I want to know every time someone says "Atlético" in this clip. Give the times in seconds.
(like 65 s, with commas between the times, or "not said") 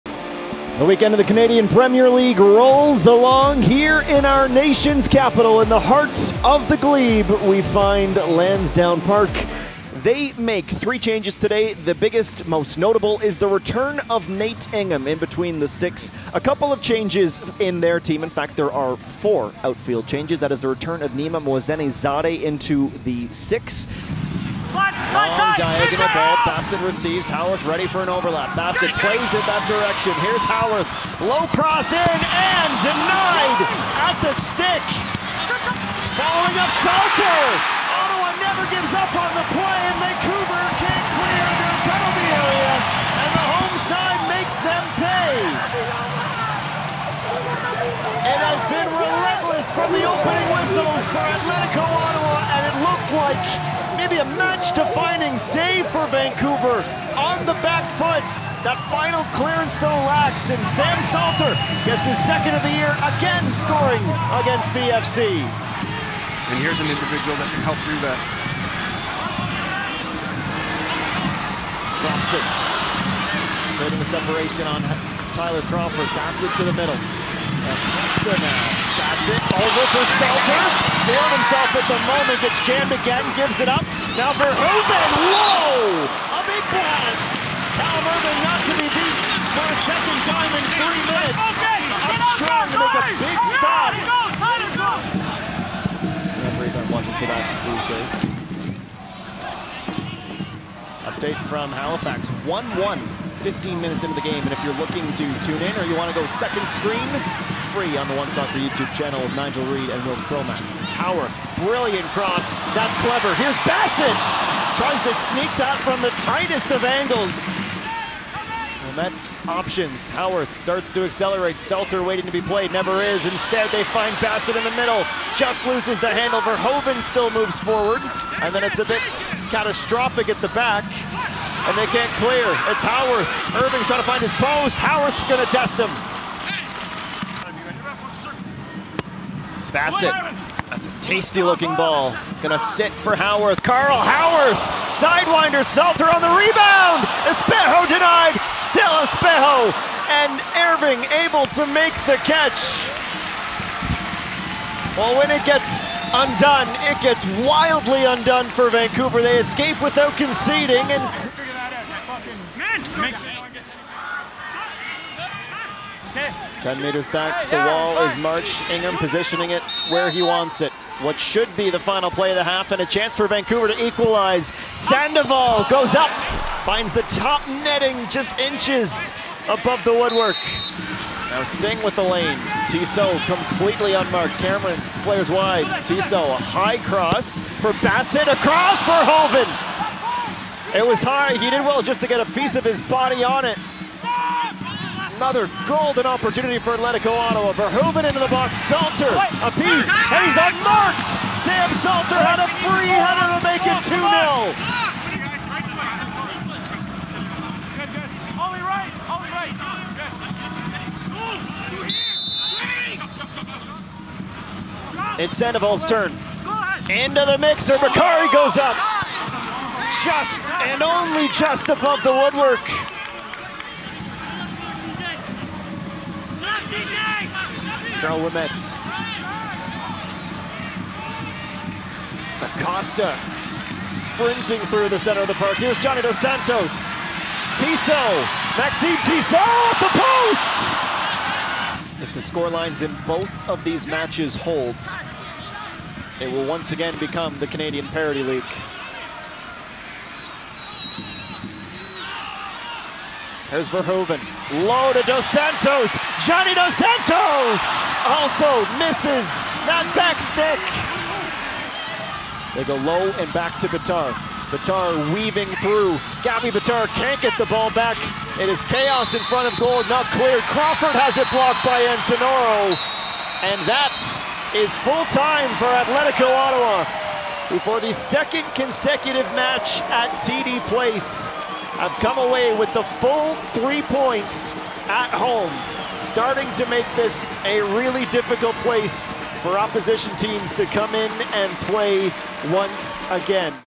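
51 s, 196 s, 275 s.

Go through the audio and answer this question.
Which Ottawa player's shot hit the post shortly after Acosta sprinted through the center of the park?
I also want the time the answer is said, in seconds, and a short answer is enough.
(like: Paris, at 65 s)
Maxime Tissot, at 238 s.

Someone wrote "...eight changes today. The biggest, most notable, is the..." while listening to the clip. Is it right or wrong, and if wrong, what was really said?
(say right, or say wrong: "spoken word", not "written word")
wrong: "three", not "eight".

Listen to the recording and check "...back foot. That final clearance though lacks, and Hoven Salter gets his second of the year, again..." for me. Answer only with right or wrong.
wrong.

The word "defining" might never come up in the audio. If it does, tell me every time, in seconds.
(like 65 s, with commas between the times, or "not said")
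54 s.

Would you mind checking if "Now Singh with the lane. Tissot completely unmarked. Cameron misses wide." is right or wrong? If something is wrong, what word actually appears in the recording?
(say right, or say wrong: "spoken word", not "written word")
wrong: "flares", not "misses".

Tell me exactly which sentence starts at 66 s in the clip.
And here's an individual that can help do that.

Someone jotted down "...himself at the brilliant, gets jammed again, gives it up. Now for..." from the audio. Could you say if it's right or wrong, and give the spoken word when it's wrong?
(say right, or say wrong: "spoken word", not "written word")
wrong: "moment", not "brilliant".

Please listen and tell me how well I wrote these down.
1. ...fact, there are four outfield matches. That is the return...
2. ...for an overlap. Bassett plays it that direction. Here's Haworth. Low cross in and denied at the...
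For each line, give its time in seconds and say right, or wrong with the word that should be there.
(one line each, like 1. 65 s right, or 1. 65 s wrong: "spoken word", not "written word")
1. 18 s wrong: "changes", not "matches"
2. 27 s right.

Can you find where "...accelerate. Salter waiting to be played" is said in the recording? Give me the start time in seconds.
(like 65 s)
121 s.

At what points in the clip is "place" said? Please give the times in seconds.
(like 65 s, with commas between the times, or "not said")
280 s, 288 s.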